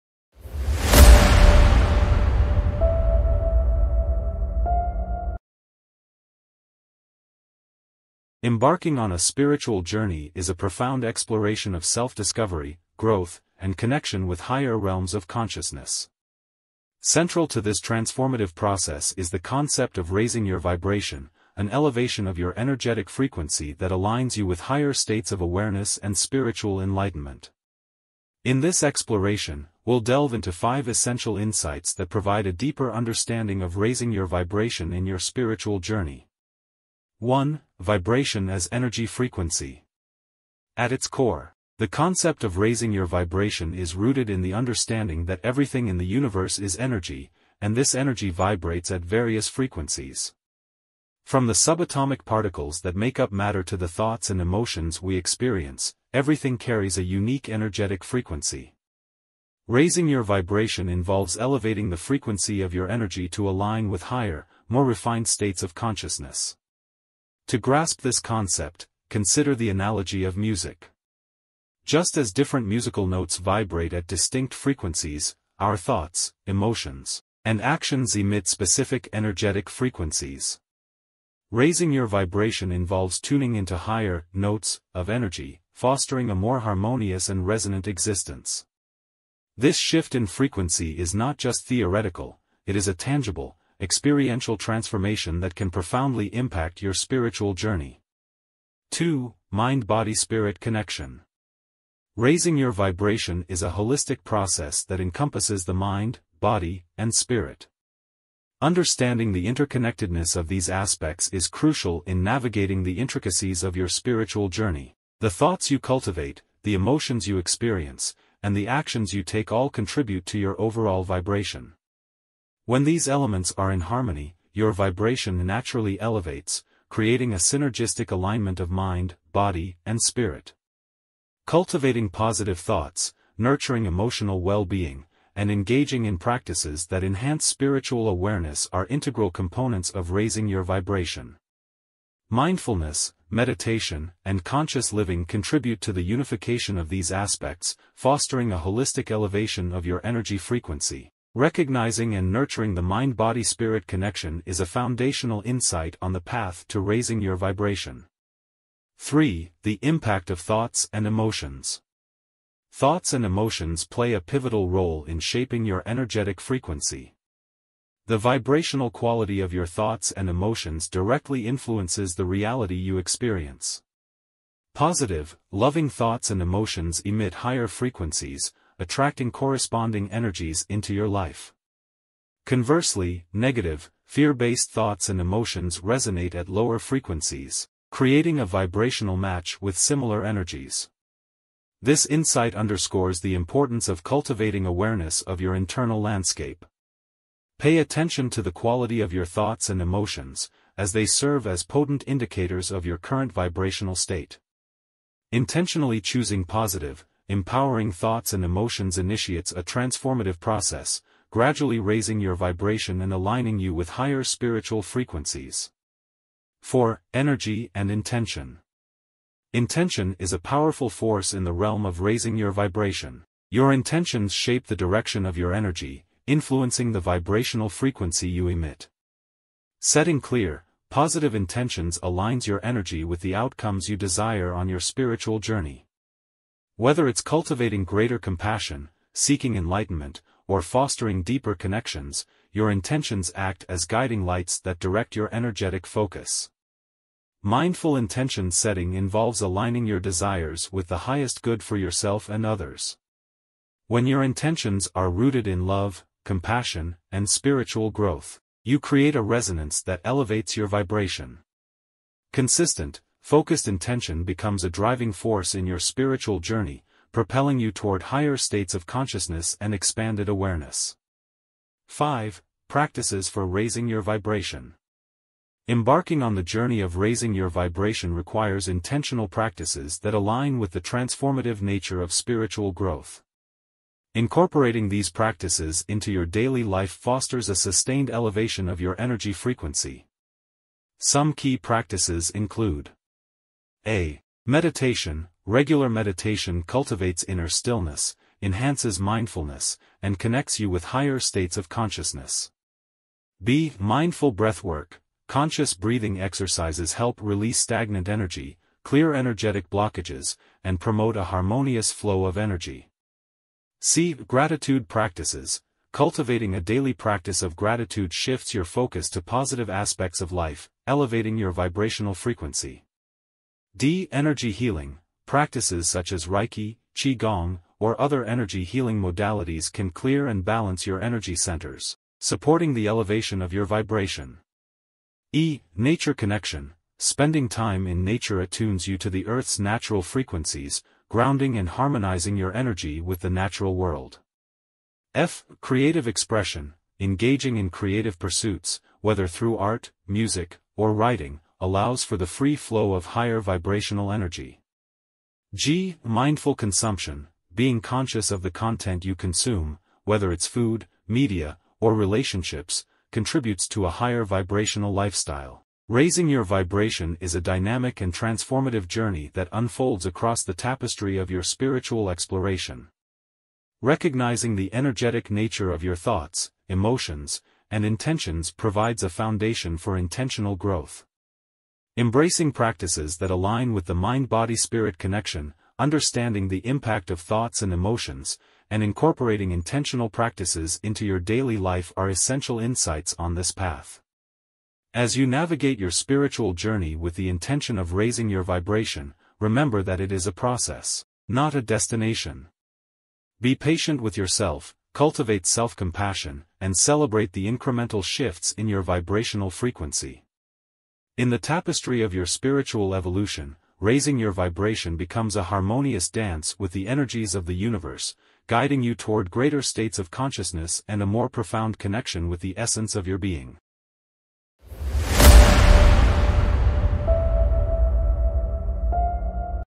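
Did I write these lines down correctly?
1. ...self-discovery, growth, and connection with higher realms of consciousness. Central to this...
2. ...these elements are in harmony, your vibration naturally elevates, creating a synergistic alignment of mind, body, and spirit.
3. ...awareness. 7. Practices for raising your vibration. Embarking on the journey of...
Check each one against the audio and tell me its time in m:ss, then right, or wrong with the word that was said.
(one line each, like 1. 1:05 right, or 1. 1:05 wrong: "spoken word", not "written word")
1. 0:11 right
2. 2:02 right
3. 4:30 wrong: "5", not "7".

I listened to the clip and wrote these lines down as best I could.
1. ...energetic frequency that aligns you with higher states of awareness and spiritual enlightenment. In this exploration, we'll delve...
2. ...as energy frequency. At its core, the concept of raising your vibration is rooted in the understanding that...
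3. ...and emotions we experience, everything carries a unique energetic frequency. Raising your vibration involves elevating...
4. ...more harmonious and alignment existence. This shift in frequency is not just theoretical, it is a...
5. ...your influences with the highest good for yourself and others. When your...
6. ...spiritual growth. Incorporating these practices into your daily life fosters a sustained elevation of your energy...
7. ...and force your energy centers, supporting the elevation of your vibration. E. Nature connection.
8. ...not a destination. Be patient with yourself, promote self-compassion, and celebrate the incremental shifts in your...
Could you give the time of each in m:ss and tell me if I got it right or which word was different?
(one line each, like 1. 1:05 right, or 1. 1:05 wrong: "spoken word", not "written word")
1. 0:22 right
2. 0:38 right
3. 0:54 right
4. 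1:26 wrong: "resonant", not "alignment"
5. 4:09 wrong: "desires", not "influences"
6. 4:42 right
7. 5:30 wrong: "balance", not "force"
8. 6:41 wrong: "cultivate", not "promote".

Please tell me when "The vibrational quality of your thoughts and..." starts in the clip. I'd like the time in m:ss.
2:48.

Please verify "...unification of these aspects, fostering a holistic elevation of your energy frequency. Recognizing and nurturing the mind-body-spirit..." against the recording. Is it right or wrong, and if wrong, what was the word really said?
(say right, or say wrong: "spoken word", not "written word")
right.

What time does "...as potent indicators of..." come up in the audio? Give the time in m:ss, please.
3:21.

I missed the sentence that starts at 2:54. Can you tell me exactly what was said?
Positive, loving thoughts and emotions emit higher frequencies, attracting corresponding energies into your life.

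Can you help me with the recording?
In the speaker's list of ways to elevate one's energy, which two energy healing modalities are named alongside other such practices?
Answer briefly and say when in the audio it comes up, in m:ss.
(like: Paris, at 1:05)
Reiki, Qigong, at 5:26.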